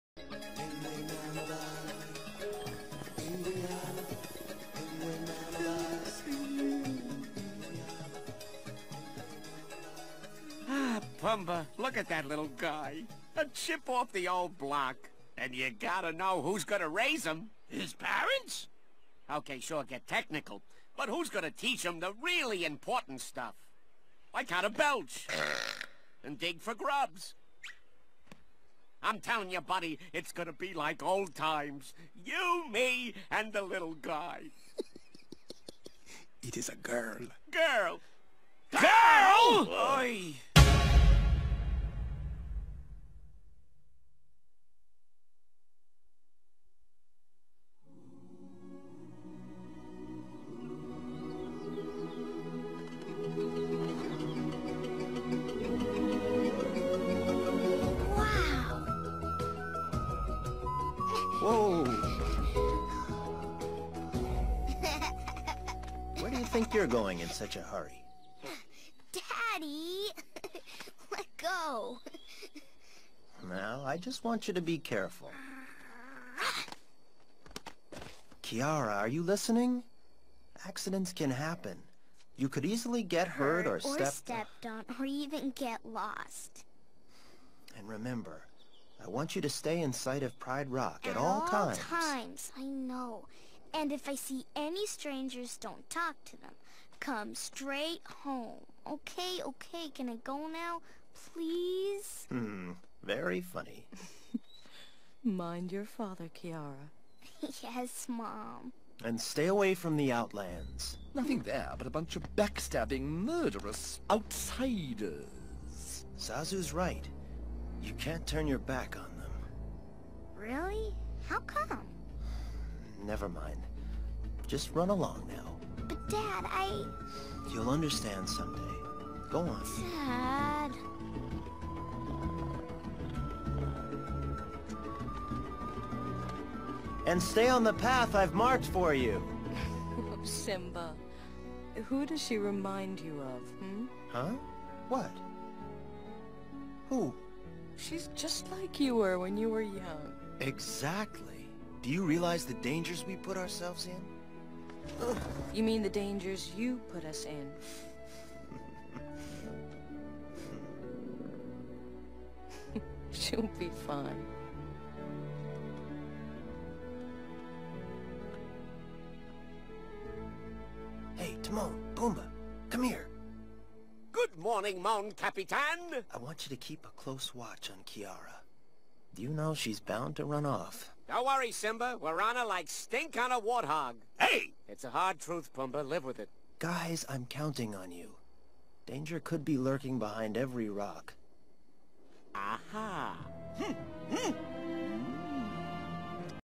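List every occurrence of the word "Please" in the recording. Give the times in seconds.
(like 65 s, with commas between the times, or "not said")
101 s.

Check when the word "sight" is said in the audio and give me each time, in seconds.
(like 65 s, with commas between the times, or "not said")
89 s.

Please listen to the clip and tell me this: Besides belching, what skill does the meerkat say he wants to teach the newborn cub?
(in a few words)
Dig for grubs.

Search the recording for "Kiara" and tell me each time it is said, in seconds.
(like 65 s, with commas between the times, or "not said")
78 s, 106 s, 177 s.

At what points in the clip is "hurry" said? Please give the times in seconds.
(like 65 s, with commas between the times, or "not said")
67 s.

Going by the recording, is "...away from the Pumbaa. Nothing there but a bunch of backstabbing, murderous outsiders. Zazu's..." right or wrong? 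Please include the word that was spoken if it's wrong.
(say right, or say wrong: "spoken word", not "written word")
wrong: "Outlands", not "Pumbaa".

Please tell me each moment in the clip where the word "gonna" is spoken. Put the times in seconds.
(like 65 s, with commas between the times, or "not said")
16 s, 21 s, 30 s.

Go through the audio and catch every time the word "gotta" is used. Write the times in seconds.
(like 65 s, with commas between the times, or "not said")
15 s.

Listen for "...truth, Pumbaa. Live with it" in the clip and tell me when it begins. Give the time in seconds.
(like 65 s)
185 s.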